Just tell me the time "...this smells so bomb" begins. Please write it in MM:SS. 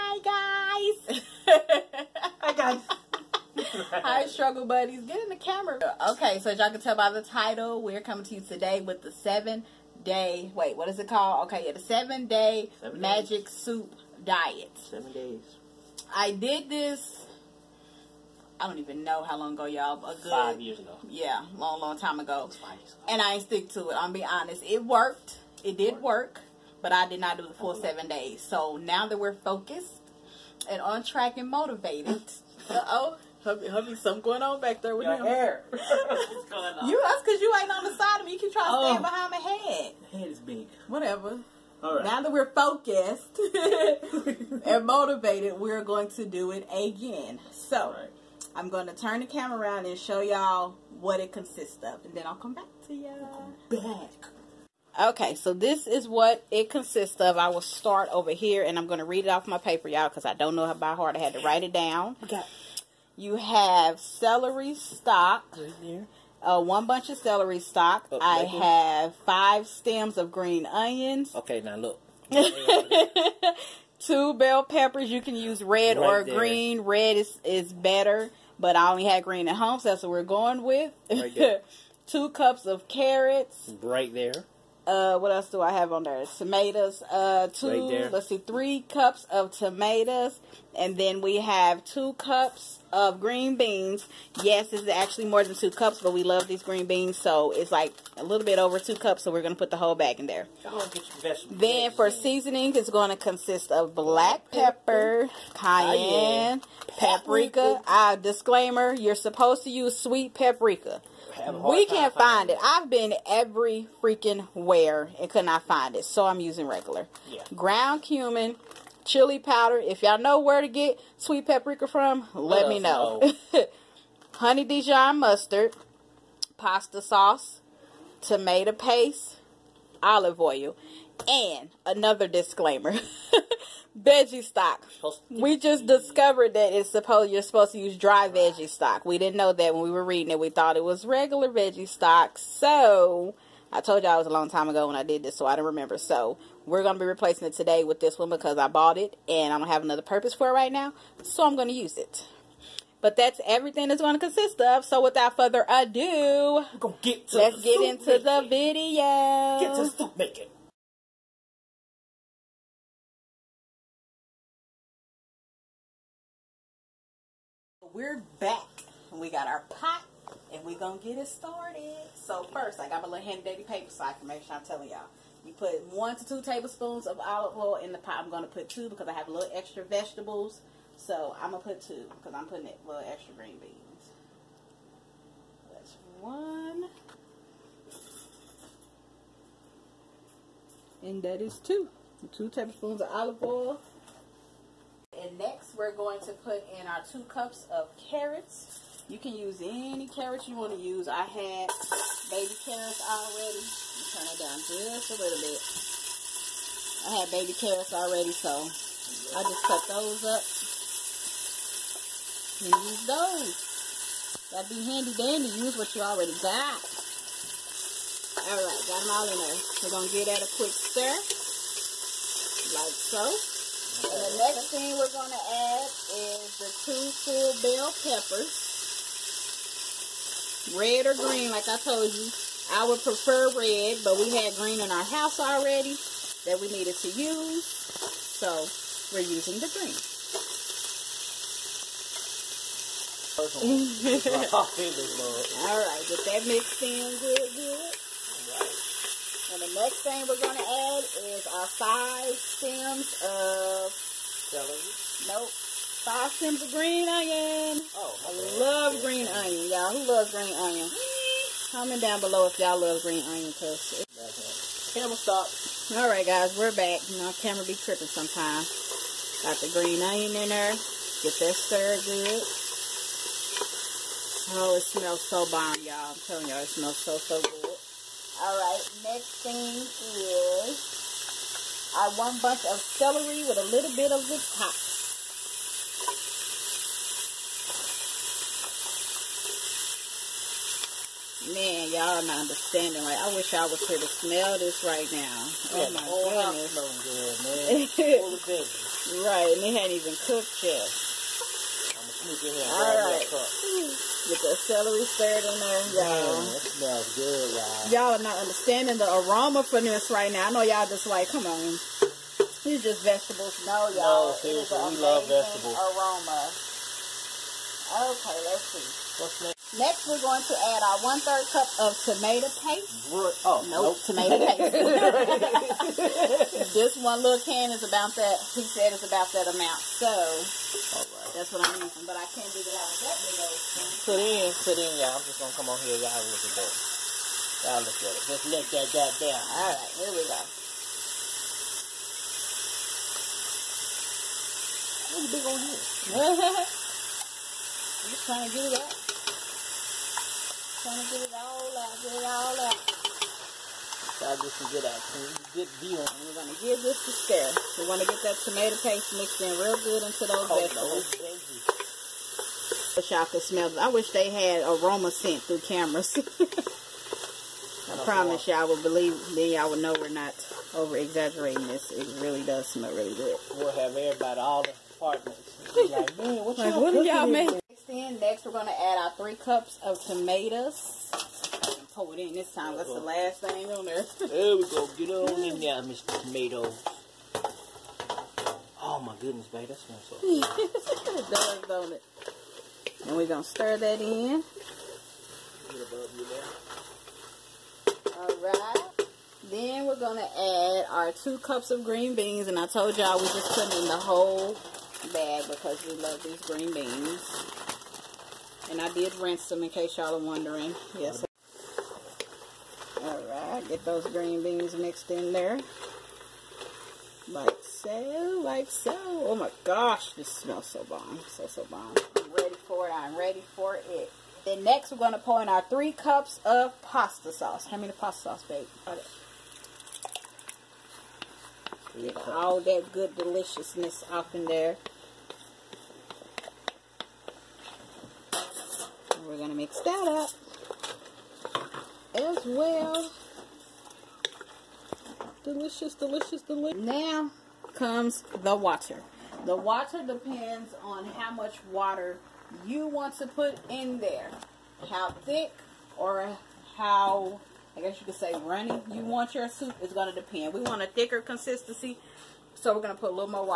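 07:00.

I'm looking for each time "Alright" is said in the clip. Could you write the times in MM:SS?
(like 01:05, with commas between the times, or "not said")
06:53.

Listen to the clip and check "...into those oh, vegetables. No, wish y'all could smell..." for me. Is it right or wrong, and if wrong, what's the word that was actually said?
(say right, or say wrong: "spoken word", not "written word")
right.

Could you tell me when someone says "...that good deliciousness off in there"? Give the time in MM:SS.
07:12.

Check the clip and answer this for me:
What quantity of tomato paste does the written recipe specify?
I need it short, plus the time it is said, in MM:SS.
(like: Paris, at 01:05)
1/3 cup, at 05:21.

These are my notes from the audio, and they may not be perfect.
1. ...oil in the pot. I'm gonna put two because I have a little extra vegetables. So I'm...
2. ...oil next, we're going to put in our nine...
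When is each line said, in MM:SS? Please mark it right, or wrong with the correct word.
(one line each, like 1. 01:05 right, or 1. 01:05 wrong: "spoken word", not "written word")
1. 02:57 right
2. 03:13 wrong: "two", not "nine".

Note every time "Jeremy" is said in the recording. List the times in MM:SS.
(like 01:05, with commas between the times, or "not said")
not said.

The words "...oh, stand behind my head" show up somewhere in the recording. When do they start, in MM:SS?
00:38.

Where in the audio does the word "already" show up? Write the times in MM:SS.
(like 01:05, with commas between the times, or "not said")
03:23, 03:27, 03:36, 03:55.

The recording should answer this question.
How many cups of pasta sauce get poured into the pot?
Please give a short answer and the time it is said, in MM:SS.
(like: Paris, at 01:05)
3 cups, at 07:05.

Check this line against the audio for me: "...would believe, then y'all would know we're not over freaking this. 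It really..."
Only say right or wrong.
wrong.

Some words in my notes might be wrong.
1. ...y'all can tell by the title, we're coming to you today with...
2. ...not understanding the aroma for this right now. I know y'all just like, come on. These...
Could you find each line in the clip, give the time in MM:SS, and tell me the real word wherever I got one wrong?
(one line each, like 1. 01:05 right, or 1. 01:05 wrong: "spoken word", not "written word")
1. 00:06 right
2. 05:08 right.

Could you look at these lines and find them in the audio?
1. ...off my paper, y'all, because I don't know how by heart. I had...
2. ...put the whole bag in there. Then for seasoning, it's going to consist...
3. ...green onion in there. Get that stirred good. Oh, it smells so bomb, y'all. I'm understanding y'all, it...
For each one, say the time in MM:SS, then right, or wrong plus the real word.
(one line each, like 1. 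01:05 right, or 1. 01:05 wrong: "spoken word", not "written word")
1. 00:59 right
2. 01:39 right
3. 04:29 wrong: "telling", not "understanding".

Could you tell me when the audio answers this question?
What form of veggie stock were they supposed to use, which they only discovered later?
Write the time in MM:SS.
02:17.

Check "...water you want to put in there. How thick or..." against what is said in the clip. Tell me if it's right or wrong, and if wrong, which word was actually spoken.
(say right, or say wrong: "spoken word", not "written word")
right.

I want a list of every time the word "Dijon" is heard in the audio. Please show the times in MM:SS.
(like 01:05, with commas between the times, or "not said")
02:04.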